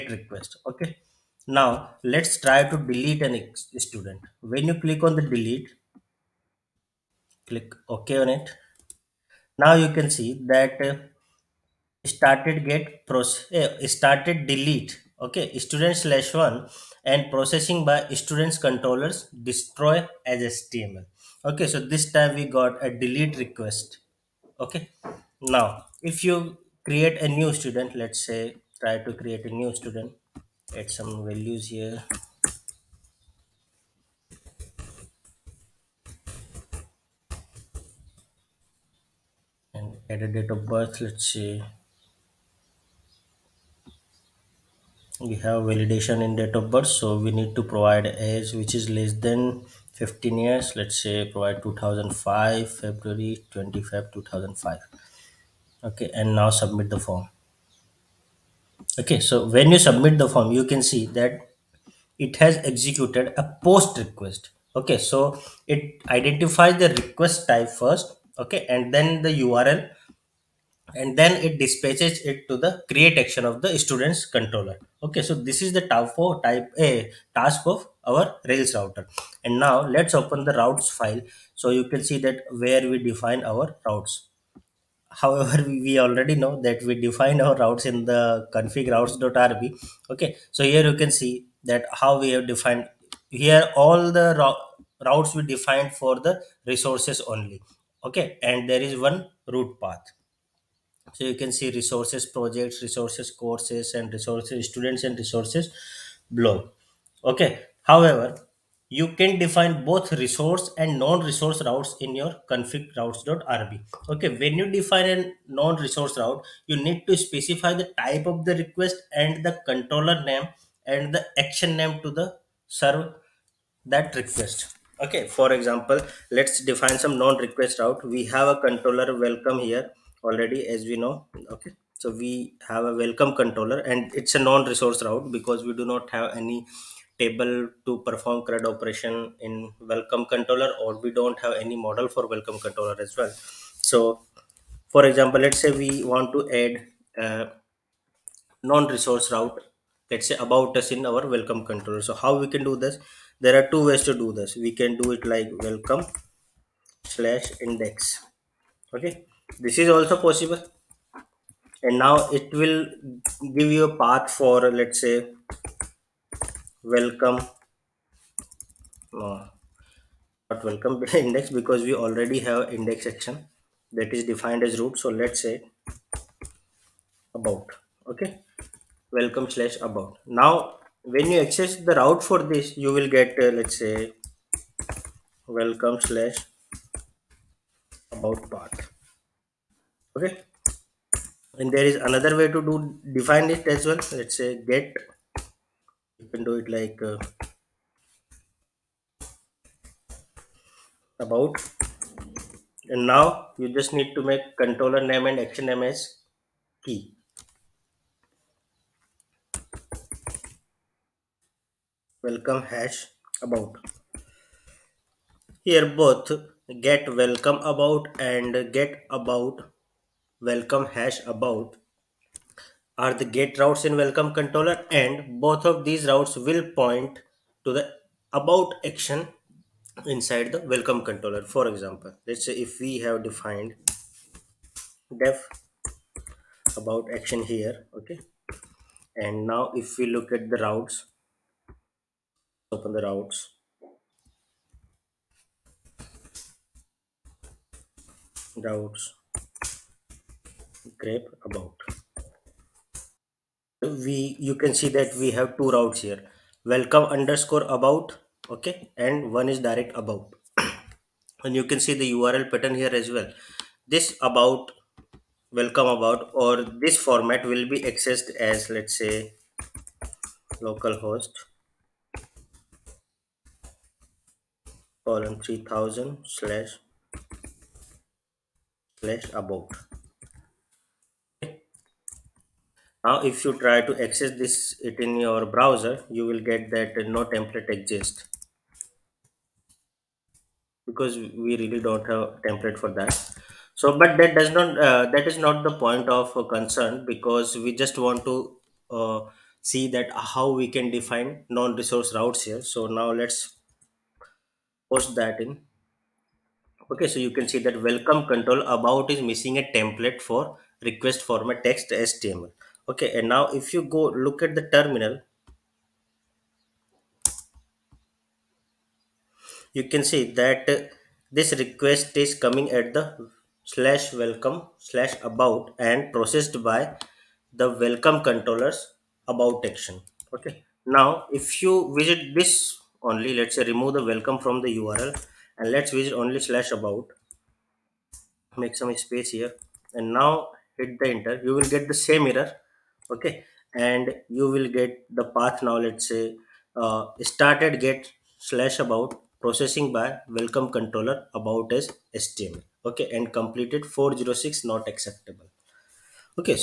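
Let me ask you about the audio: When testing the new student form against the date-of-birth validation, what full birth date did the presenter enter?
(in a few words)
February 25, 2005.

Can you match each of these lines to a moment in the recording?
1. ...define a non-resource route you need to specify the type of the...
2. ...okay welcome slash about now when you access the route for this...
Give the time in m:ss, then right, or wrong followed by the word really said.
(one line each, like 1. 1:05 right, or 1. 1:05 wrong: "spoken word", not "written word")
1. 1:54 right
2. 2:58 right.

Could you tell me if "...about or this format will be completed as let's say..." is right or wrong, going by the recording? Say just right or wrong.
wrong.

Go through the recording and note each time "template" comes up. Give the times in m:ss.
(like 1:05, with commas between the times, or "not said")
4:47, 4:52, 5:09.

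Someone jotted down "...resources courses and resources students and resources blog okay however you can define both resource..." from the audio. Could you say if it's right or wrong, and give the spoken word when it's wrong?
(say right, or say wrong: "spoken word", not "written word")
right.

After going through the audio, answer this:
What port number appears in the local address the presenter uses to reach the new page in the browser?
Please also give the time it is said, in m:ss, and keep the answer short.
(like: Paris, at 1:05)
3000, at 4:35.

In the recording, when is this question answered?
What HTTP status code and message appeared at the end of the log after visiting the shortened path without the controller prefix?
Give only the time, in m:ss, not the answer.
5:53.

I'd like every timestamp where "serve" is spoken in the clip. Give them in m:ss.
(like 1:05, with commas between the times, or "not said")
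2:02.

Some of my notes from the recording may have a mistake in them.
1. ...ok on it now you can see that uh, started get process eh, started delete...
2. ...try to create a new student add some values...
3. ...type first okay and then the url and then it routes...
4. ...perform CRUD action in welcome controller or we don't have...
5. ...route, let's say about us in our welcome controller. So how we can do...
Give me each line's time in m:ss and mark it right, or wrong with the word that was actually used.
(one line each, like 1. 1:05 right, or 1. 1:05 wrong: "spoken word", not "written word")
1. 0:07 right
2. 0:28 right
3. 1:07 wrong: "dispatches", not "routes"
4. 2:18 wrong: "operation", not "action"
5. 2:29 right.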